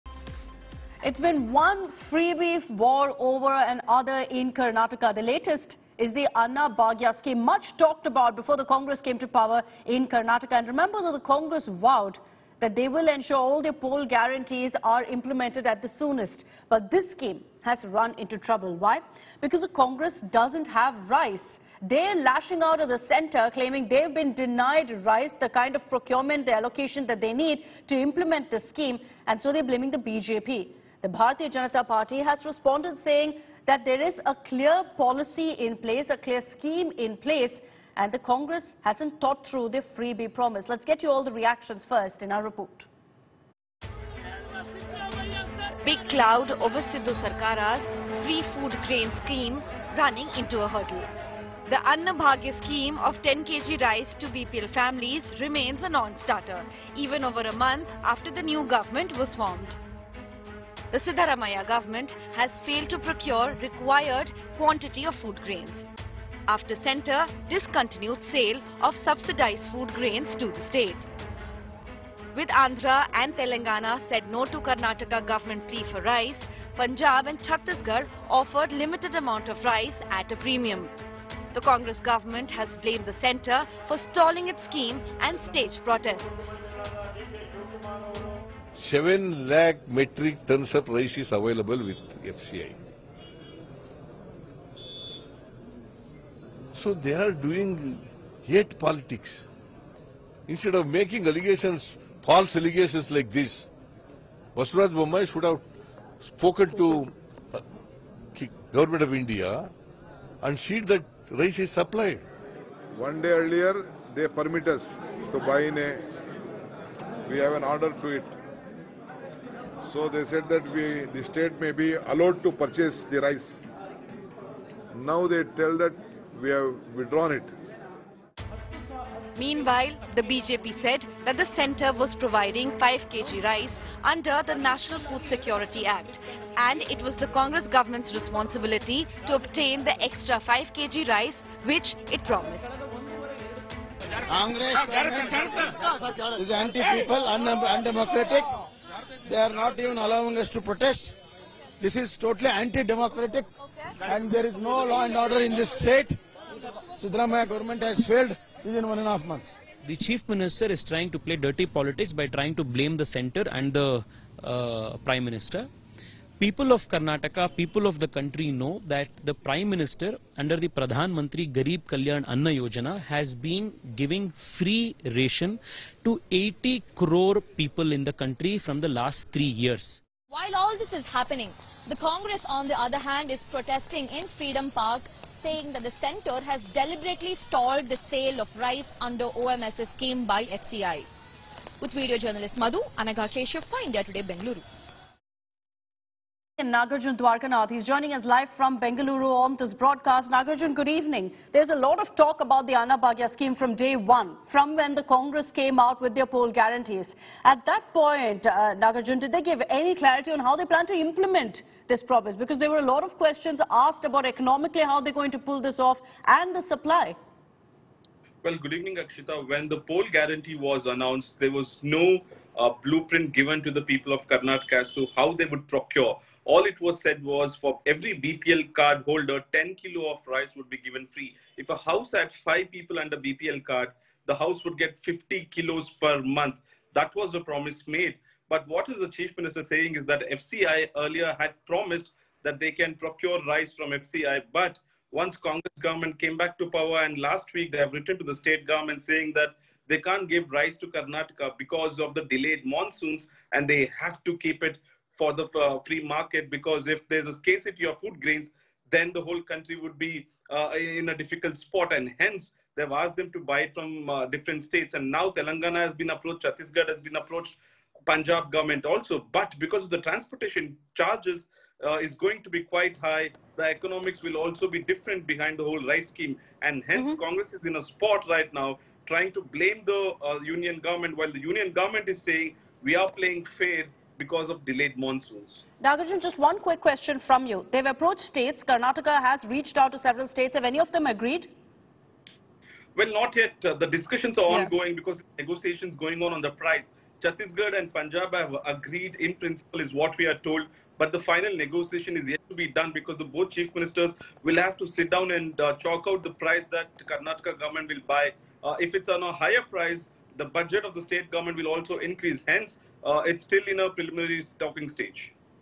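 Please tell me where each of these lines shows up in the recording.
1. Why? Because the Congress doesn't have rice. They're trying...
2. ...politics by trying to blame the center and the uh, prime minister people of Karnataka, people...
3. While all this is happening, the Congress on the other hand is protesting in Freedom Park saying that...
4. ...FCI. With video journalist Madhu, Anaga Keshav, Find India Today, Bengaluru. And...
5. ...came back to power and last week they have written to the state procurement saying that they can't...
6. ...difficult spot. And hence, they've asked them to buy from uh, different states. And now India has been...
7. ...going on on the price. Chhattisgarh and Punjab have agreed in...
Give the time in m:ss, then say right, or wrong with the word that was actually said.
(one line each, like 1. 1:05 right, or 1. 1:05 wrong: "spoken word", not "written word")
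1. 0:18 wrong: "lashing", not "trying"
2. 2:41 right
3. 3:00 right
4. 3:10 right
5. 4:06 wrong: "government", not "procurement"
6. 4:21 wrong: "Telangana", not "India"
7. 4:55 right.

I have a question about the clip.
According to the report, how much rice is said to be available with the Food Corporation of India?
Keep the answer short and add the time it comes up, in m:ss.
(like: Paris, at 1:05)
7 lakh metric tons, at 1:28.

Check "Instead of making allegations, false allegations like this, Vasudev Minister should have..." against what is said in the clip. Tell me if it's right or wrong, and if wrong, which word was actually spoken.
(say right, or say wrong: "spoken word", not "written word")
wrong: "Bommai", not "Minister".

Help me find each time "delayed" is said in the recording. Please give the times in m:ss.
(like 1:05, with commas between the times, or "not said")
4:12, 4:44.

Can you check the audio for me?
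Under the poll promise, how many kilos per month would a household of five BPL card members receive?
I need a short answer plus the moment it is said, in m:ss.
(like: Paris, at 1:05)
50 kilos, at 3:55.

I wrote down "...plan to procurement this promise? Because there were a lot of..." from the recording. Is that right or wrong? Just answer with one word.
wrong.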